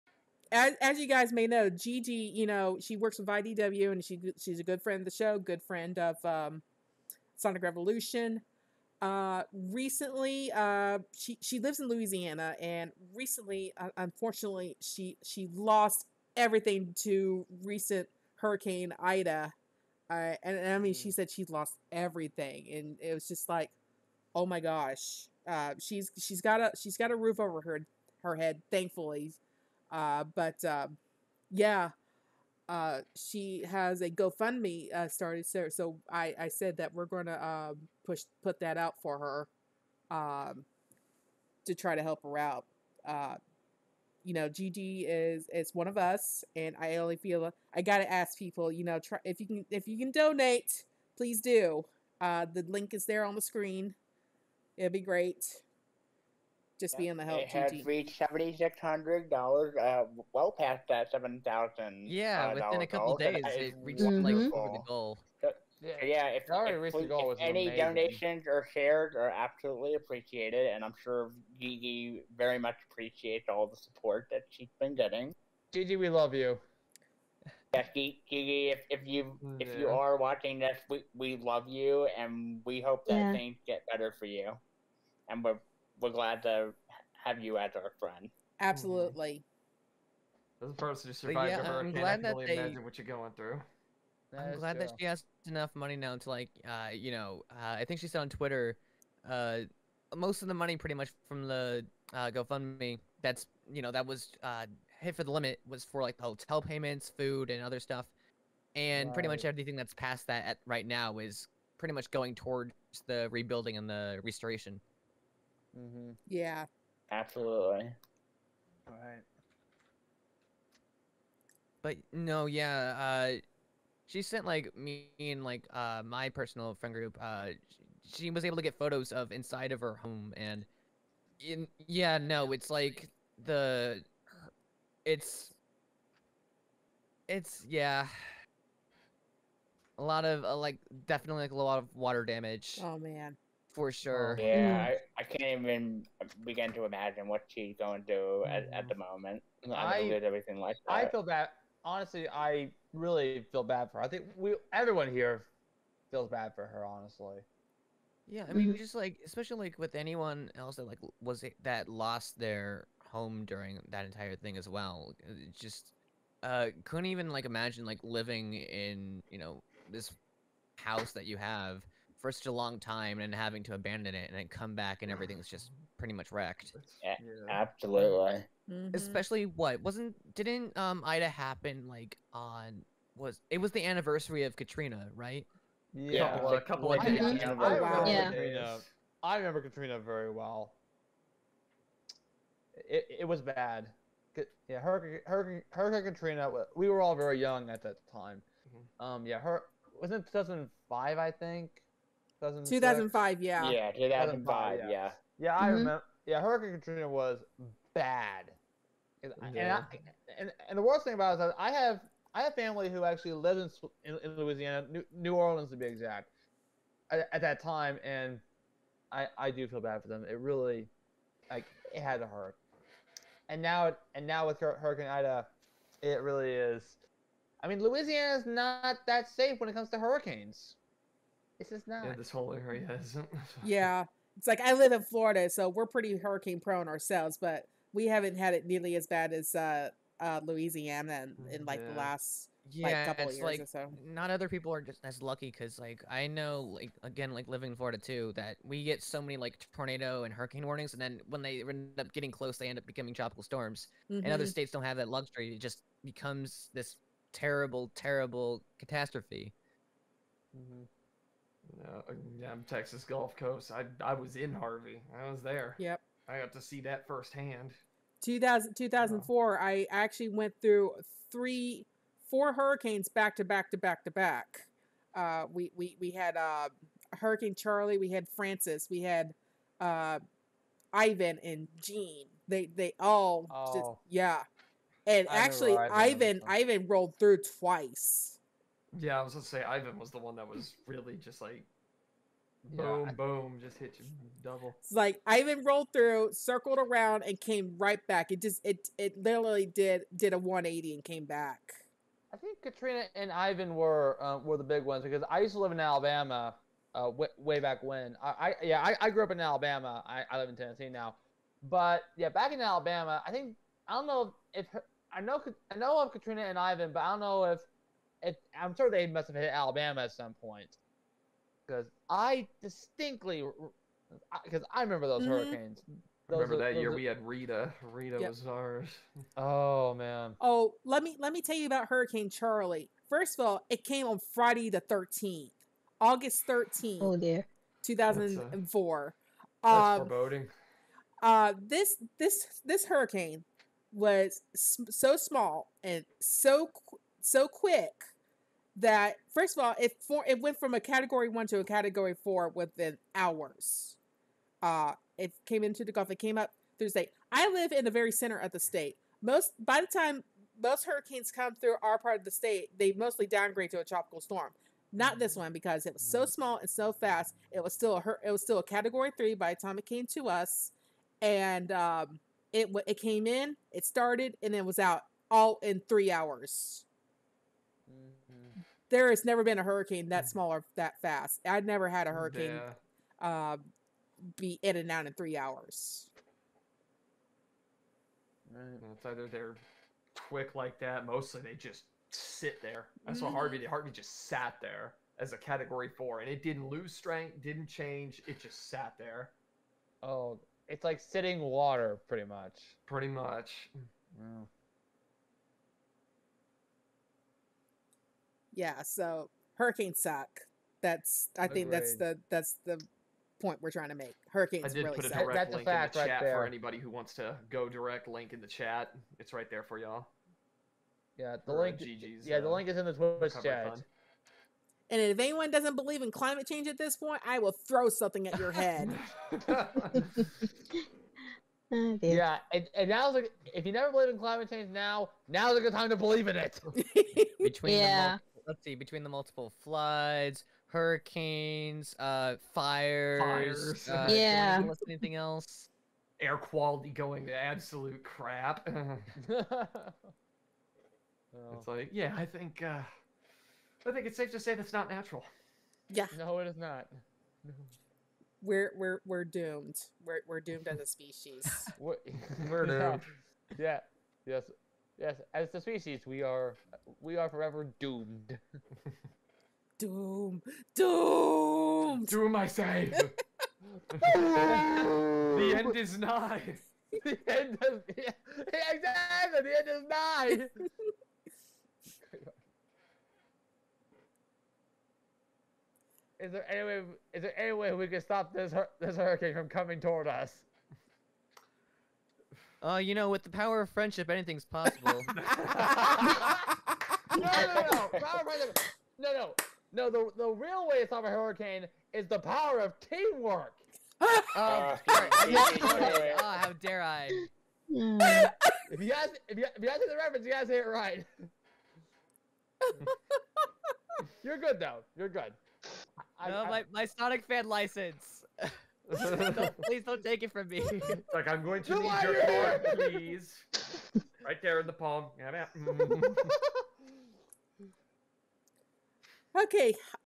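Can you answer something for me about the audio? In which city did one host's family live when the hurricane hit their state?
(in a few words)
New Orleans.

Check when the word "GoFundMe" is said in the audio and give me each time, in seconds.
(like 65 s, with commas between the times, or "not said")
34 s, 102 s.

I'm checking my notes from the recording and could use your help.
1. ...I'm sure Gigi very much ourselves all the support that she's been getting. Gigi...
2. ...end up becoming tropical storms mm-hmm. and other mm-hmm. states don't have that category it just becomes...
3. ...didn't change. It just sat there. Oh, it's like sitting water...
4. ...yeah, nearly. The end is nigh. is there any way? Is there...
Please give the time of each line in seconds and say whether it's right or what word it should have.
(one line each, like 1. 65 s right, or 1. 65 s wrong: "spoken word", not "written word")
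1. 70 s wrong: "appreciates", not "ourselves"
2. 252 s wrong: "luxury", not "category"
3. 397 s right
4. 477 s wrong: "exactly", not "nearly".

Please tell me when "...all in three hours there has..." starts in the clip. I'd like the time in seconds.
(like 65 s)
375 s.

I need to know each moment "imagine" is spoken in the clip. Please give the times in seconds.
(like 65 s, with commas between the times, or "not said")
92 s, 146 s, 167 s.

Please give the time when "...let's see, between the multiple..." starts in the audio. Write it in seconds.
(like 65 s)
438 s.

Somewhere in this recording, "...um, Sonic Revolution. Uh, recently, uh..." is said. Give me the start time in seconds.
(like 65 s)
6 s.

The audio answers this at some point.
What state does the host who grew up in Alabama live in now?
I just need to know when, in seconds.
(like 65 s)
310 s.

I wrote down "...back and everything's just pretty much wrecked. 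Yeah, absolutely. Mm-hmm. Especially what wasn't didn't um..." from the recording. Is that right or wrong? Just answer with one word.
right.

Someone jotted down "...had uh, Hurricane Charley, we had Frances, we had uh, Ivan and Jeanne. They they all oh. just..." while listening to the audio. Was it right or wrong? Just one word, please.
right.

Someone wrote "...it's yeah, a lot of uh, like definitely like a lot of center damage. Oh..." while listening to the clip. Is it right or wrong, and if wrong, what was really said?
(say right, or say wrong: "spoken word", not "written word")
wrong: "water", not "center".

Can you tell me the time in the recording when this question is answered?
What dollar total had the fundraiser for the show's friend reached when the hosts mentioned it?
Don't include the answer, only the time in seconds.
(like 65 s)
58 s.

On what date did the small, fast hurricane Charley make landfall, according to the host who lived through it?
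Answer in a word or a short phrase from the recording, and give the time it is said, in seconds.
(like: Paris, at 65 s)
Friday August 13, at 334 s.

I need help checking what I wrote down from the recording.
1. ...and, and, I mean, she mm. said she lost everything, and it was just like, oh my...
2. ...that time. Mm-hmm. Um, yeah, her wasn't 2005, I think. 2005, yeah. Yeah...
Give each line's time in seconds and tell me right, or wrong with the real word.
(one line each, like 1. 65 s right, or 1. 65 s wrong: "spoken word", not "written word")
1. 20 s right
2. 197 s right.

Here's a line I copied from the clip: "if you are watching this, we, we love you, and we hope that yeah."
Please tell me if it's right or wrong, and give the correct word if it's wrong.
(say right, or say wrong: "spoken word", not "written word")
right.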